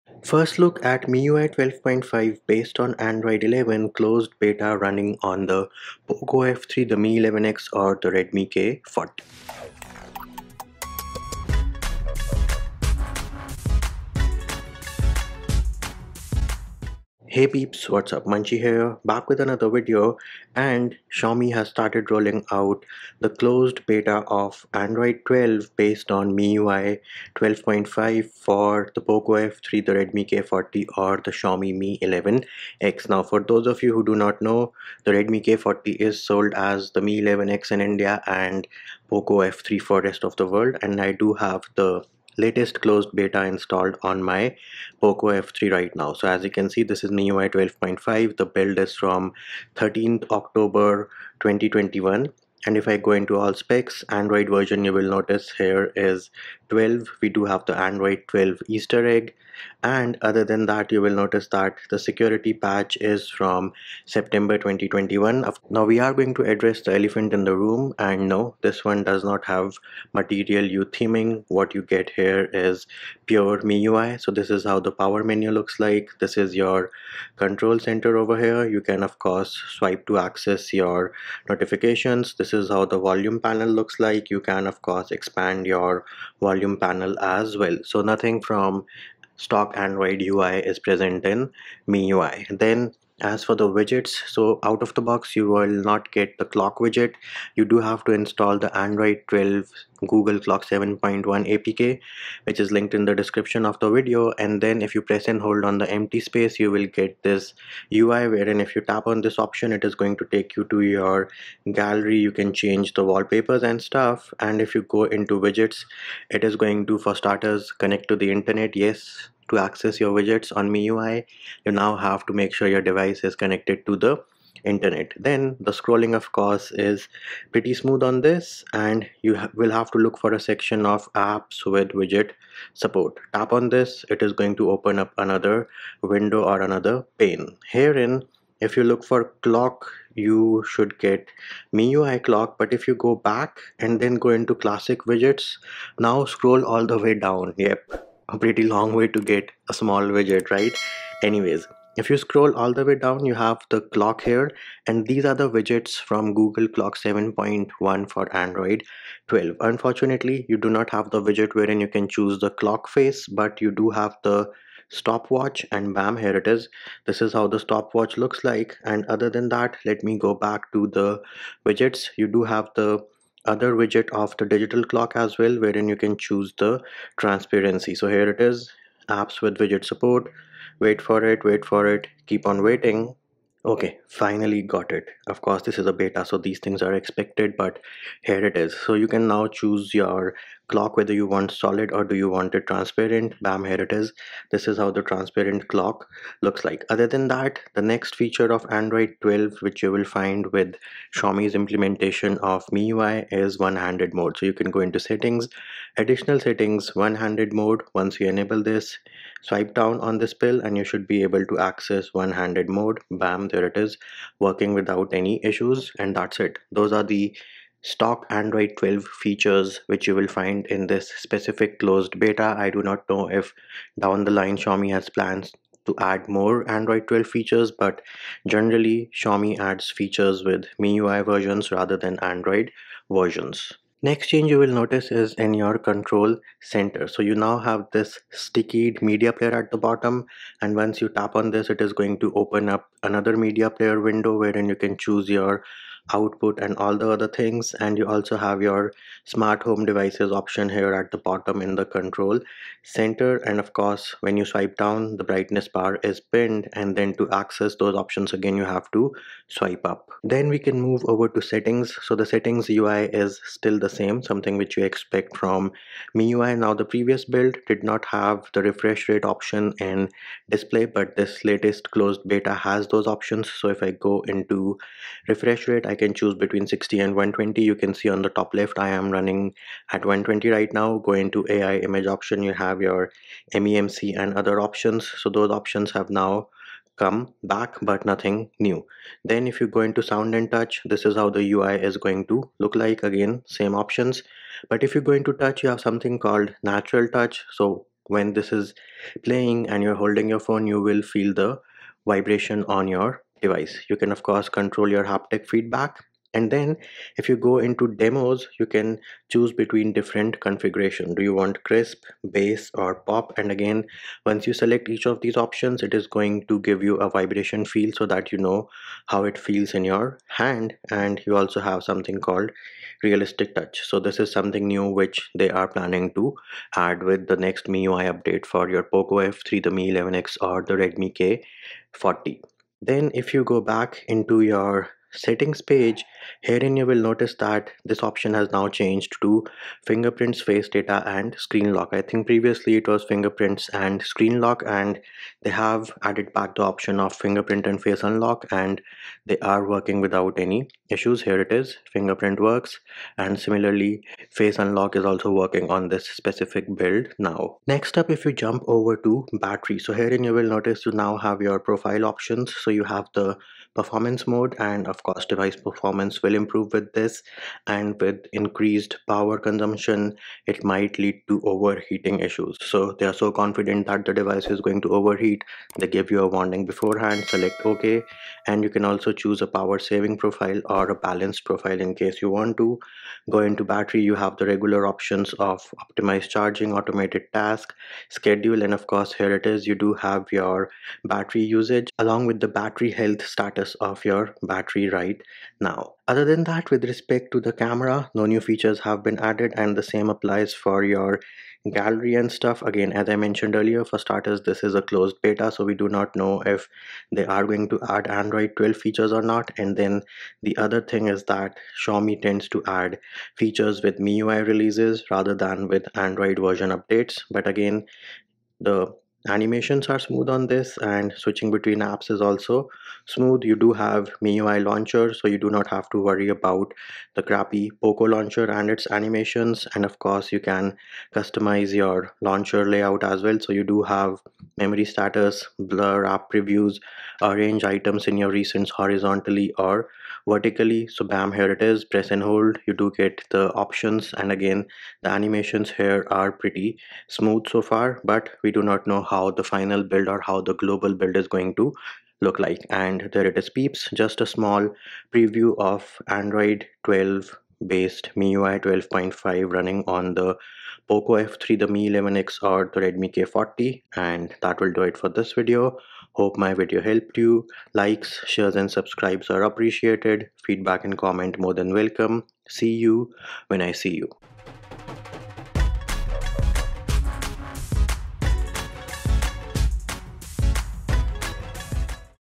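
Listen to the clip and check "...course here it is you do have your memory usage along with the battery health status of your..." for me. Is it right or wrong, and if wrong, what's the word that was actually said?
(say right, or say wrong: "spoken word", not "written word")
wrong: "battery", not "memory".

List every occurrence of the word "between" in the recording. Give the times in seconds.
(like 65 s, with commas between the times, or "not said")
276 s, 309 s, 421 s.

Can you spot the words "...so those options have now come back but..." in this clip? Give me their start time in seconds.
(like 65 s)
285 s.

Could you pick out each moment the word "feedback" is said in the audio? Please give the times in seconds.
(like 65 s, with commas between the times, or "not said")
305 s, 470 s.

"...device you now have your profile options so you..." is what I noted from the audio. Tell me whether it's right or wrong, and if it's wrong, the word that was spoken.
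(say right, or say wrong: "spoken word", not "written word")
wrong: "notice", not "device".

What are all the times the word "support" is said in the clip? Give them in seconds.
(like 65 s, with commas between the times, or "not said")
132 s, 179 s.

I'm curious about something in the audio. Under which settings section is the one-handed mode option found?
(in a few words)
Additional settings.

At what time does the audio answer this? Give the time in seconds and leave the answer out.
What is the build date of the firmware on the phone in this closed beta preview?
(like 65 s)
49 s.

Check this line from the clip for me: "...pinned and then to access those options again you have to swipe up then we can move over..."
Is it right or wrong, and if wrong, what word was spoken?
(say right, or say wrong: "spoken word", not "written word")
right.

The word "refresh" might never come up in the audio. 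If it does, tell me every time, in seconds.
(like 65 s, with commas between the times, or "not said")
268 s, 275 s.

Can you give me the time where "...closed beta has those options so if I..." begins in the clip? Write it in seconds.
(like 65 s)
271 s.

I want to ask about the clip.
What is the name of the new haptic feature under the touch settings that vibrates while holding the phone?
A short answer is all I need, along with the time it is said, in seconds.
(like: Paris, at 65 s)
Natural touch, at 296 s.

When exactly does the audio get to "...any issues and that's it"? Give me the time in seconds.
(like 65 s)
215 s.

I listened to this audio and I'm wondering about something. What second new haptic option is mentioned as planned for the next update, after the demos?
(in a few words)
Realistic touch.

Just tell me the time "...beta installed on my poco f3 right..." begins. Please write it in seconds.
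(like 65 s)
43 s.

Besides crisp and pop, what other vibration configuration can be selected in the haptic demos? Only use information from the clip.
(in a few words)
Bass.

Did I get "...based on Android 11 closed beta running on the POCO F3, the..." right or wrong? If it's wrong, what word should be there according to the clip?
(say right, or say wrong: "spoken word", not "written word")
right.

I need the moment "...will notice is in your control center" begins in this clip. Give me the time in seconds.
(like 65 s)
234 s.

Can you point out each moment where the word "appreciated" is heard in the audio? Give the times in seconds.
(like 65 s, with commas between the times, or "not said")
469 s.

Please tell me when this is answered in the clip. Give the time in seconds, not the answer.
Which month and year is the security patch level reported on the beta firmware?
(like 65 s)
64 s.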